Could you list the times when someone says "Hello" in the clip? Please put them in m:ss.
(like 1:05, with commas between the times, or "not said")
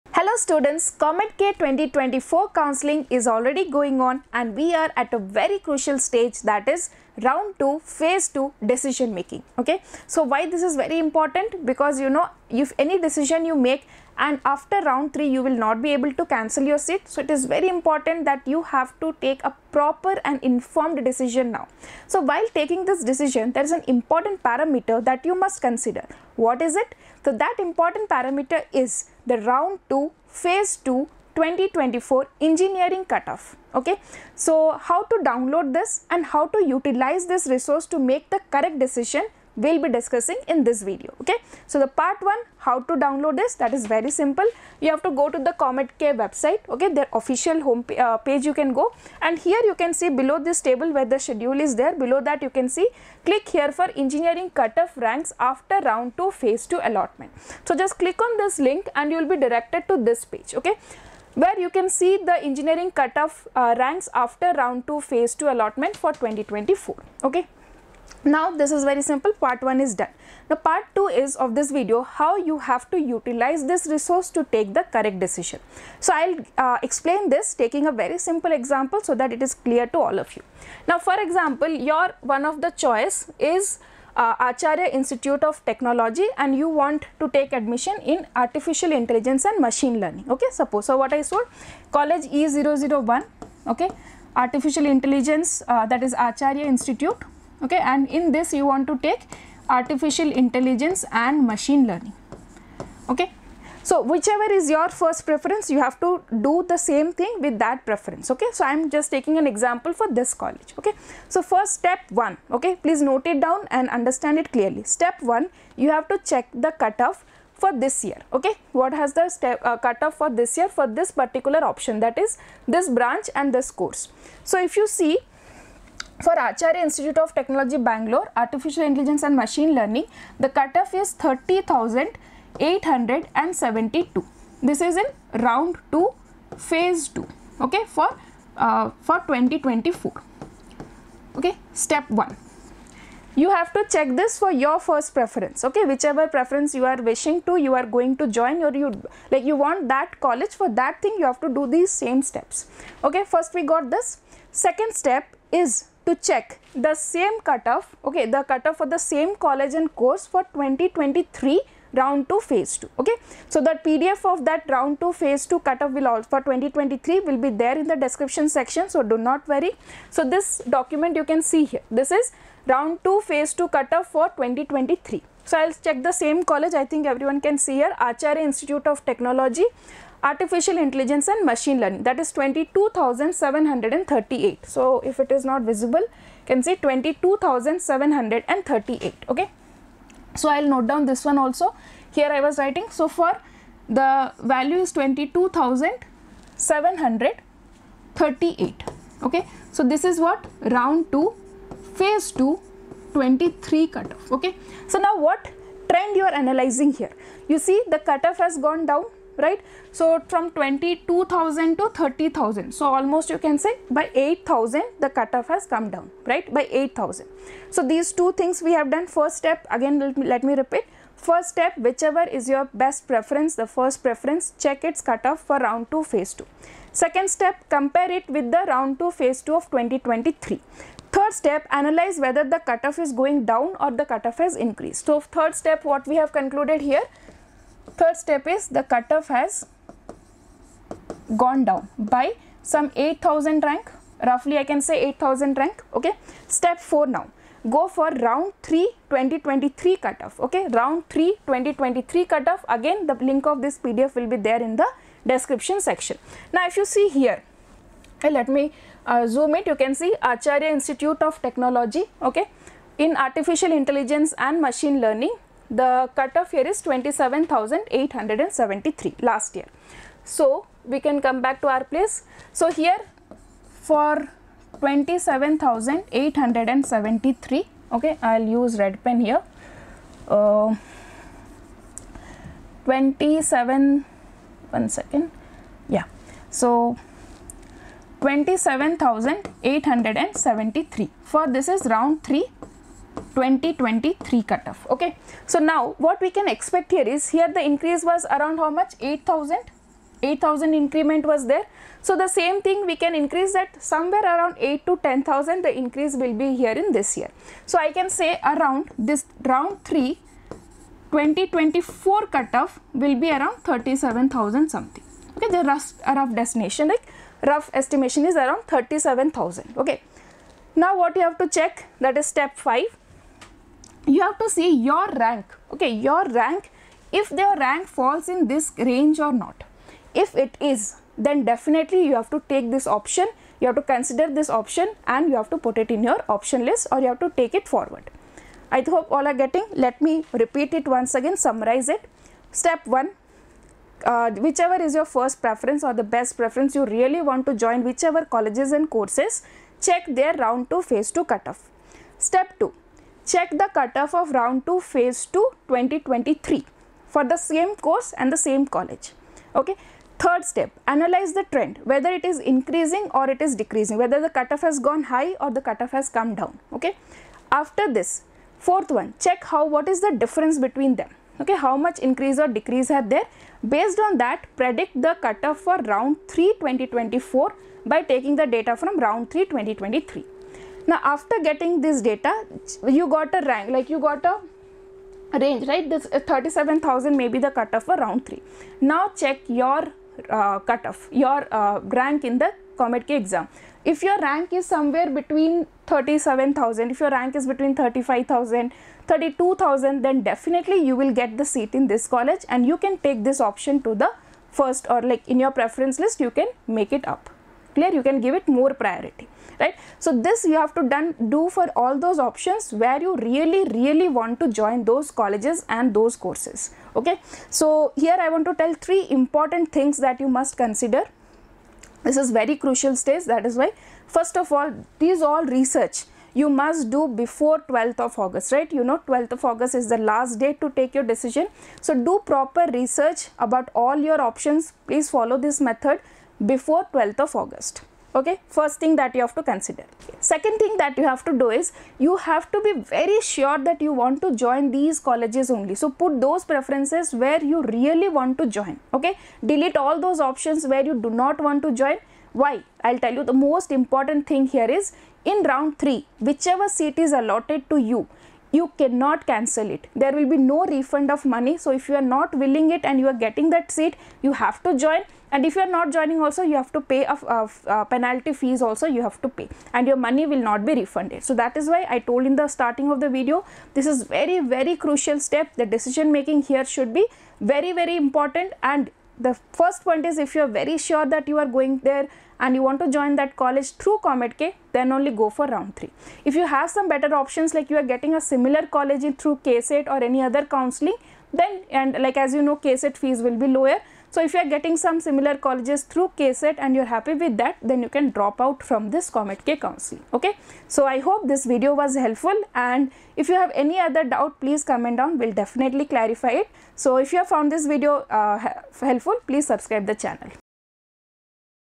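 0:00.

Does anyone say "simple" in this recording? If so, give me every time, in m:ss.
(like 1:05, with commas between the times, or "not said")
0:44, 1:09, 1:18.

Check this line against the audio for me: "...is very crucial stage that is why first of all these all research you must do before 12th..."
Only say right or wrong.
right.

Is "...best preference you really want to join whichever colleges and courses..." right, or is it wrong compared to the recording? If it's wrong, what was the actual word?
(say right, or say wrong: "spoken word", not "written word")
right.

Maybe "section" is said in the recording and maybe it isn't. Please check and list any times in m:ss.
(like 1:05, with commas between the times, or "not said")
2:48, 4:15.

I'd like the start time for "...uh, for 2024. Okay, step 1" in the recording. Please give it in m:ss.
2:18.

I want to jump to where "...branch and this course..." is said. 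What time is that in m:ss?
2:02.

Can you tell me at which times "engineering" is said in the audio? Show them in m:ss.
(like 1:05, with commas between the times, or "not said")
0:32, 0:54, 1:02.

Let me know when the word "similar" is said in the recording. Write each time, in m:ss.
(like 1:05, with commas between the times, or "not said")
8:08, 8:15.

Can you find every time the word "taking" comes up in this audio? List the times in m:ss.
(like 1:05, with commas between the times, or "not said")
0:22, 1:17, 1:49, 6:18.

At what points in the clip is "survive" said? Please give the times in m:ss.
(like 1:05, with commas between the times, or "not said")
not said.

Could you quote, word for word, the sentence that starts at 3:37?
So, these two things we have done.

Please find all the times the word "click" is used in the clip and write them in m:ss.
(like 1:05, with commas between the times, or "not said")
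0:53, 0:57.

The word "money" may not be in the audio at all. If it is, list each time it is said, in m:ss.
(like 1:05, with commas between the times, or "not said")
7:41, 7:49.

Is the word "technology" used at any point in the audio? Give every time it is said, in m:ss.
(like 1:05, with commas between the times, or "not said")
1:25, 2:07, 2:59, 4:21.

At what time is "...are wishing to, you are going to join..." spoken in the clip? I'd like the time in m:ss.
2:26.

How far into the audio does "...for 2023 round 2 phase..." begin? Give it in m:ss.
2:40.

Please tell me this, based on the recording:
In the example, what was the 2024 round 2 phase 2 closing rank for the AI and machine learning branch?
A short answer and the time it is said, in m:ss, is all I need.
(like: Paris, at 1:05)
30,872, at 2:11.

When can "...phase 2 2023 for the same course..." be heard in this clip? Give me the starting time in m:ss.
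5:54.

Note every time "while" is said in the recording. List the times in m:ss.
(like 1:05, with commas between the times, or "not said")
0:22.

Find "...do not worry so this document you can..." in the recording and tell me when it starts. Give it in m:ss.
2:49.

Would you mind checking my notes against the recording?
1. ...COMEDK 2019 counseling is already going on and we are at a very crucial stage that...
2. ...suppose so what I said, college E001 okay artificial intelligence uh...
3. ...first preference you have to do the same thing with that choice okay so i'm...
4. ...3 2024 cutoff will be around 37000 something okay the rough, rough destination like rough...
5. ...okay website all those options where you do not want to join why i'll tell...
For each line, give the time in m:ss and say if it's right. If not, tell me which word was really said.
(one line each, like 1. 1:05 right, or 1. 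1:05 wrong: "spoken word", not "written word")
1. 0:00 wrong: "2024", not "2019"
2. 1:30 right
3. 1:44 wrong: "preference", not "choice"
4. 5:09 right
5. 7:28 wrong: "delete", not "website".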